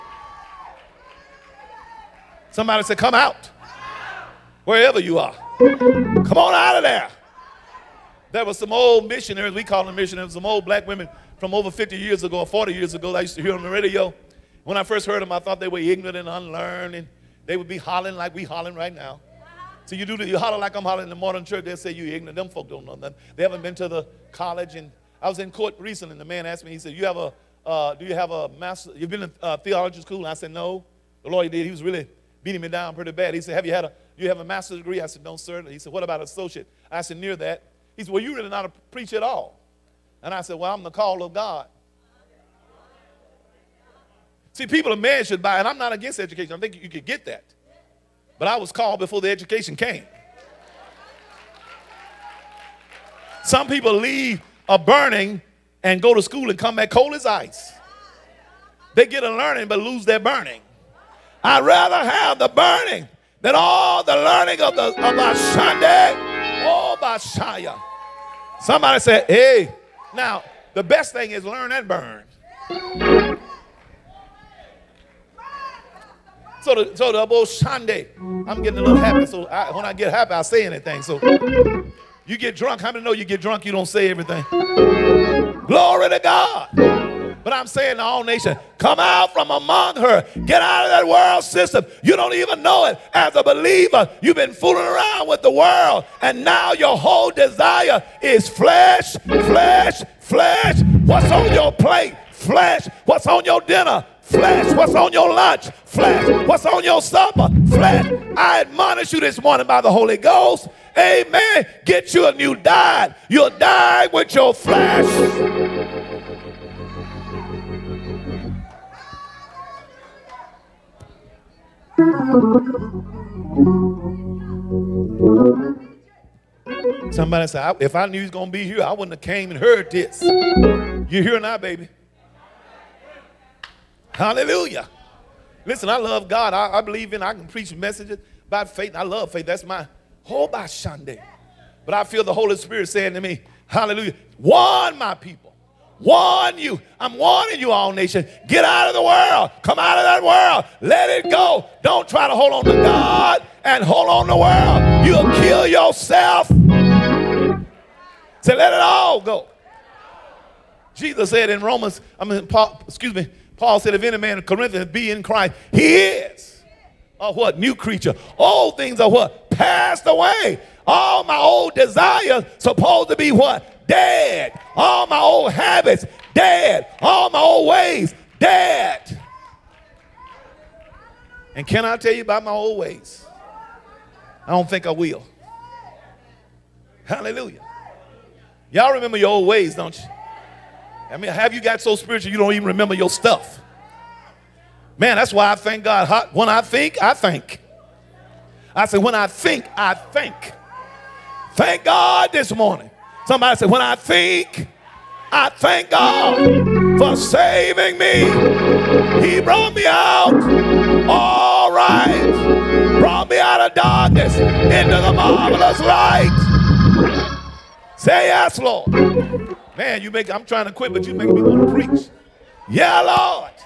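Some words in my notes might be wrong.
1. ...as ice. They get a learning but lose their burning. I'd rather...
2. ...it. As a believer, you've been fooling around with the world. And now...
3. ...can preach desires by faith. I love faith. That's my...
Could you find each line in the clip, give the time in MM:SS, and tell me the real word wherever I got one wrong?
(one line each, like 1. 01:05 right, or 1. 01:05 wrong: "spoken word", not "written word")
1. 00:57 right
2. 01:32 right
3. 02:17 wrong: "messages", not "desires".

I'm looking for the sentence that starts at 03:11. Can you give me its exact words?
I mean, have you got so spiritual you don't even remember your stuff?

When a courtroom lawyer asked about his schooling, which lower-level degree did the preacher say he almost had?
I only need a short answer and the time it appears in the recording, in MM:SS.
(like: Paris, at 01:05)
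Associate, at 00:36.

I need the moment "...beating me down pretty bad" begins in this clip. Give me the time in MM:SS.
00:32.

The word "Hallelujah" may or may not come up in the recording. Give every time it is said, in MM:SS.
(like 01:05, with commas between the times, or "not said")
02:14, 02:23, 03:07.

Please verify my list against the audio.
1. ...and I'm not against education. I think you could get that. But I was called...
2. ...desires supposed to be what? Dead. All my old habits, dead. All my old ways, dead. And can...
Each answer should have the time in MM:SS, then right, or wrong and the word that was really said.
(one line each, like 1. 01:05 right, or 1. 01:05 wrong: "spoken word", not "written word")
1. 00:45 right
2. 02:51 right.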